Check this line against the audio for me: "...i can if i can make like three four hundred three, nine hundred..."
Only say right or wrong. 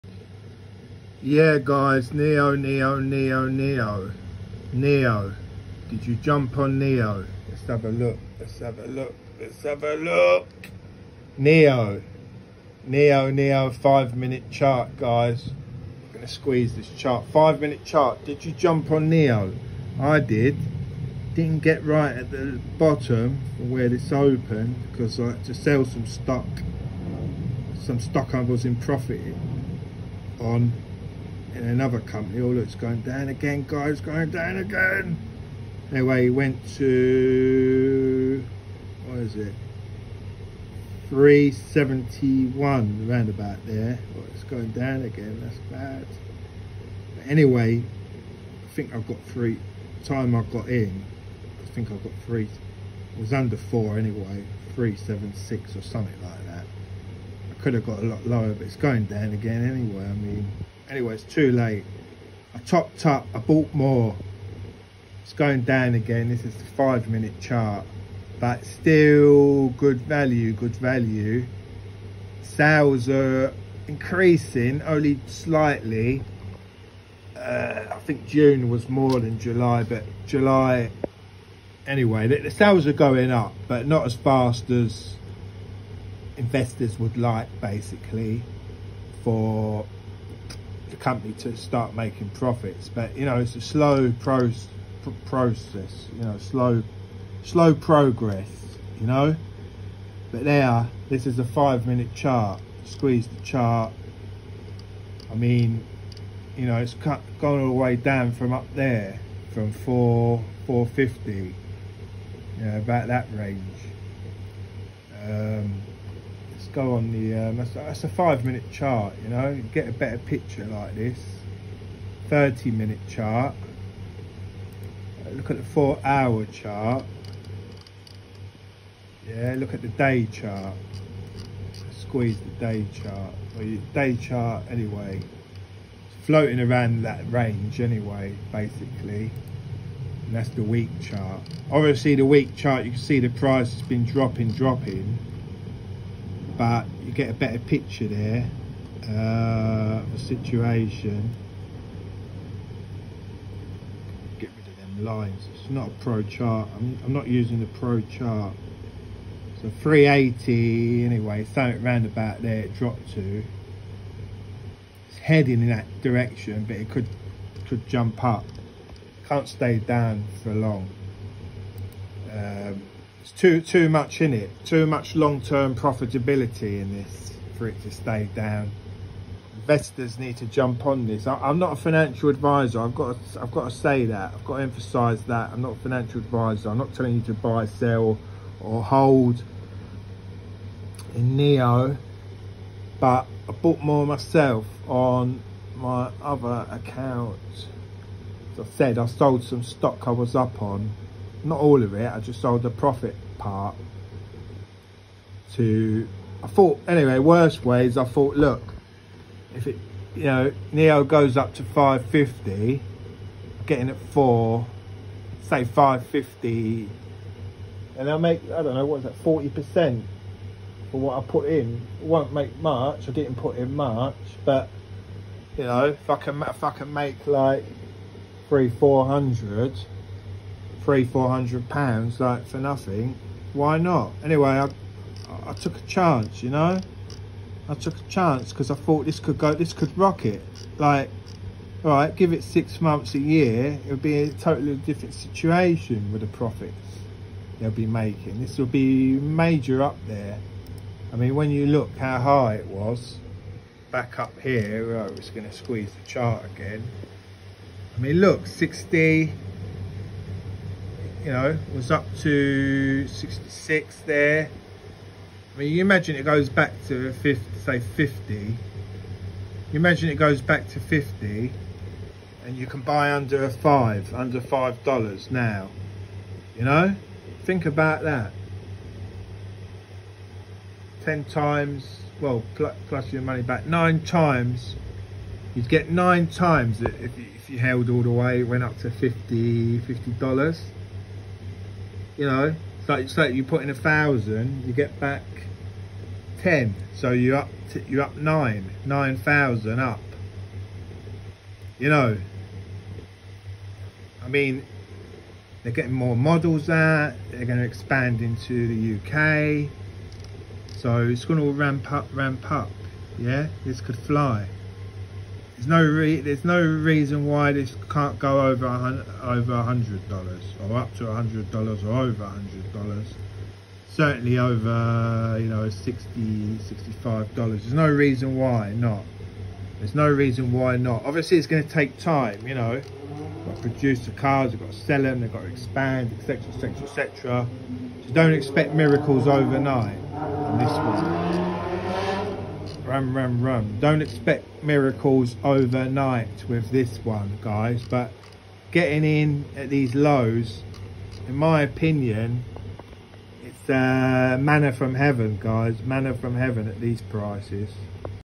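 wrong.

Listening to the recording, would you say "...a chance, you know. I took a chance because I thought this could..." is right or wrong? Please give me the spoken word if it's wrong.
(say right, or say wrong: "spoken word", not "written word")
right.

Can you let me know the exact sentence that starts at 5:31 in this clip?
Obviously, it's going to take time.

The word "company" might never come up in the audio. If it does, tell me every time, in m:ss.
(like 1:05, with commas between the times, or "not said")
0:32, 1:30.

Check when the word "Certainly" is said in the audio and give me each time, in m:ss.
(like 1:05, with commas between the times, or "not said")
5:23.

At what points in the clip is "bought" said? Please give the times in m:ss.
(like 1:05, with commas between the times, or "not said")
1:03, 3:13.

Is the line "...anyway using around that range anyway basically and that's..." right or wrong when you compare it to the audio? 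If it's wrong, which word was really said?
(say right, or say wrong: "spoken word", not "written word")
wrong: "floating", not "using".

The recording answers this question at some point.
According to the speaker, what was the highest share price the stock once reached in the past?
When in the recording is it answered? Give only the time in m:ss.
4:23.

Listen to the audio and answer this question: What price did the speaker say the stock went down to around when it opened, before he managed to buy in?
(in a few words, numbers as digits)
371.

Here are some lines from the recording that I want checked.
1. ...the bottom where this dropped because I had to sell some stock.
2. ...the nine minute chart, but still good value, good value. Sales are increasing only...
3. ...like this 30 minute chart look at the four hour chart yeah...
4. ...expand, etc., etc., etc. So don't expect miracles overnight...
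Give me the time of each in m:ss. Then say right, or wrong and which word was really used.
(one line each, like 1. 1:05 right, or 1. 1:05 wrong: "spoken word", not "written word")
1. 0:22 wrong: "opened", not "dropped"
2. 1:06 wrong: "five", not "nine"
3. 2:00 right
4. 5:35 right.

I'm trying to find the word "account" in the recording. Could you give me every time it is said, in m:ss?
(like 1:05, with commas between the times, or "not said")
3:16.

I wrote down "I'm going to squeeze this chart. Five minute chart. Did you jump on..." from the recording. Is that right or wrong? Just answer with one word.
right.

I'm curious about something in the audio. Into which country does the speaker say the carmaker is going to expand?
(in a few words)
UK.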